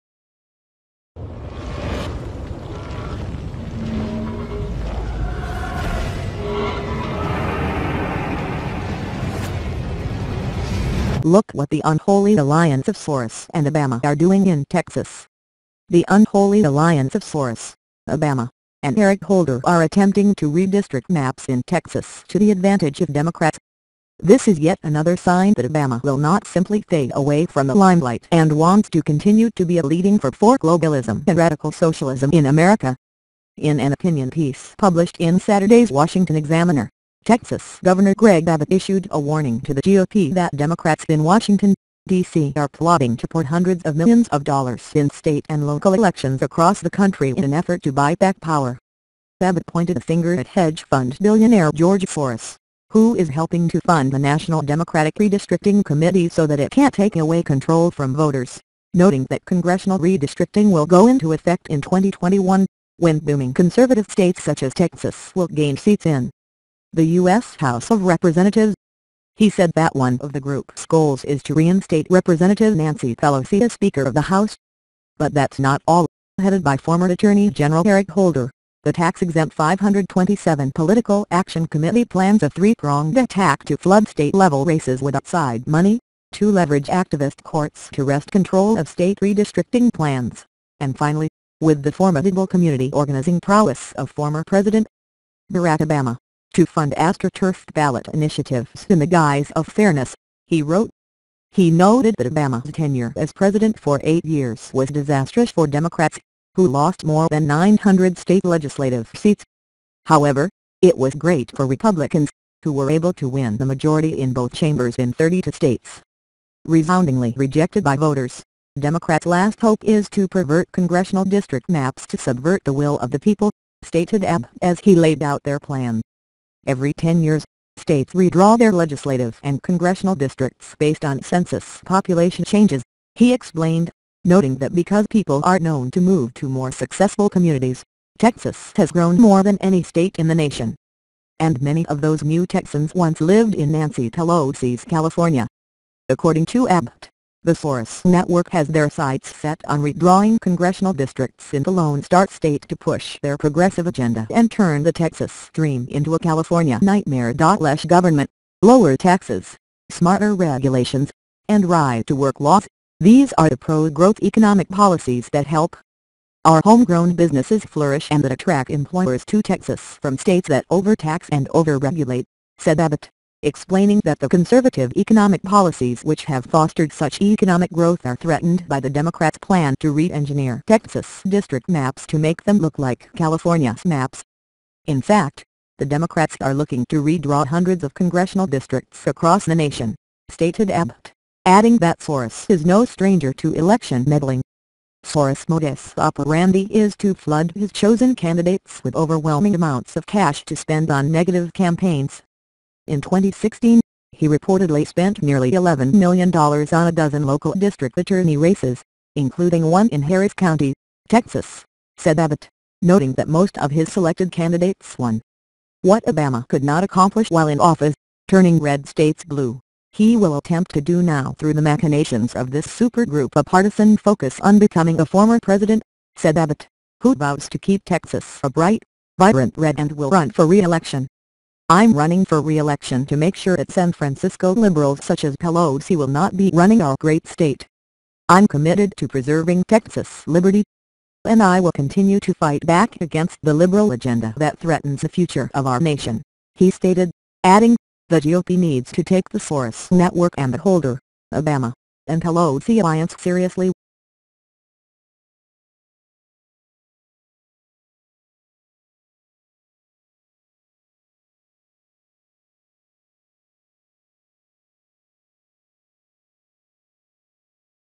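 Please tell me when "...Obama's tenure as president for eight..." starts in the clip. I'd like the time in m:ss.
1:42.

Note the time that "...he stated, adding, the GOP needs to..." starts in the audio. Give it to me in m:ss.
4:06.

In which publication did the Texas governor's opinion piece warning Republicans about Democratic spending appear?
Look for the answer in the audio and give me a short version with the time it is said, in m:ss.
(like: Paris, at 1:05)
Washington Examiner, at 0:35.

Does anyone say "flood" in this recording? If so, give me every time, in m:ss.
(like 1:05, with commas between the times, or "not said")
1:23, 3:17.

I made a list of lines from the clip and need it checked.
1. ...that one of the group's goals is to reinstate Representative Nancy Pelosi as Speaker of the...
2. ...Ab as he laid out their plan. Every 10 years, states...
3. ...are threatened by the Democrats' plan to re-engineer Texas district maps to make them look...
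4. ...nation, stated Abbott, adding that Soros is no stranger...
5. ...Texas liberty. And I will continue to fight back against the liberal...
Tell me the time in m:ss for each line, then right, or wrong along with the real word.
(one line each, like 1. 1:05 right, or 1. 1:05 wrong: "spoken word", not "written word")
1. 1:09 right
2. 2:04 right
3. 2:58 right
4. 3:09 right
5. 3:59 right.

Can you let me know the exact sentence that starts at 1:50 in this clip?
However, it was great for Republicans, who were able to win the majority in both chambers in 32 states.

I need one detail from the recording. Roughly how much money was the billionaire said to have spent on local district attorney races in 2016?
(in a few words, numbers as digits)
nearly $11 million.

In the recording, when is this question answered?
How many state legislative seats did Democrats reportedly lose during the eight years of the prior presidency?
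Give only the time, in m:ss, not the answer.
1:47.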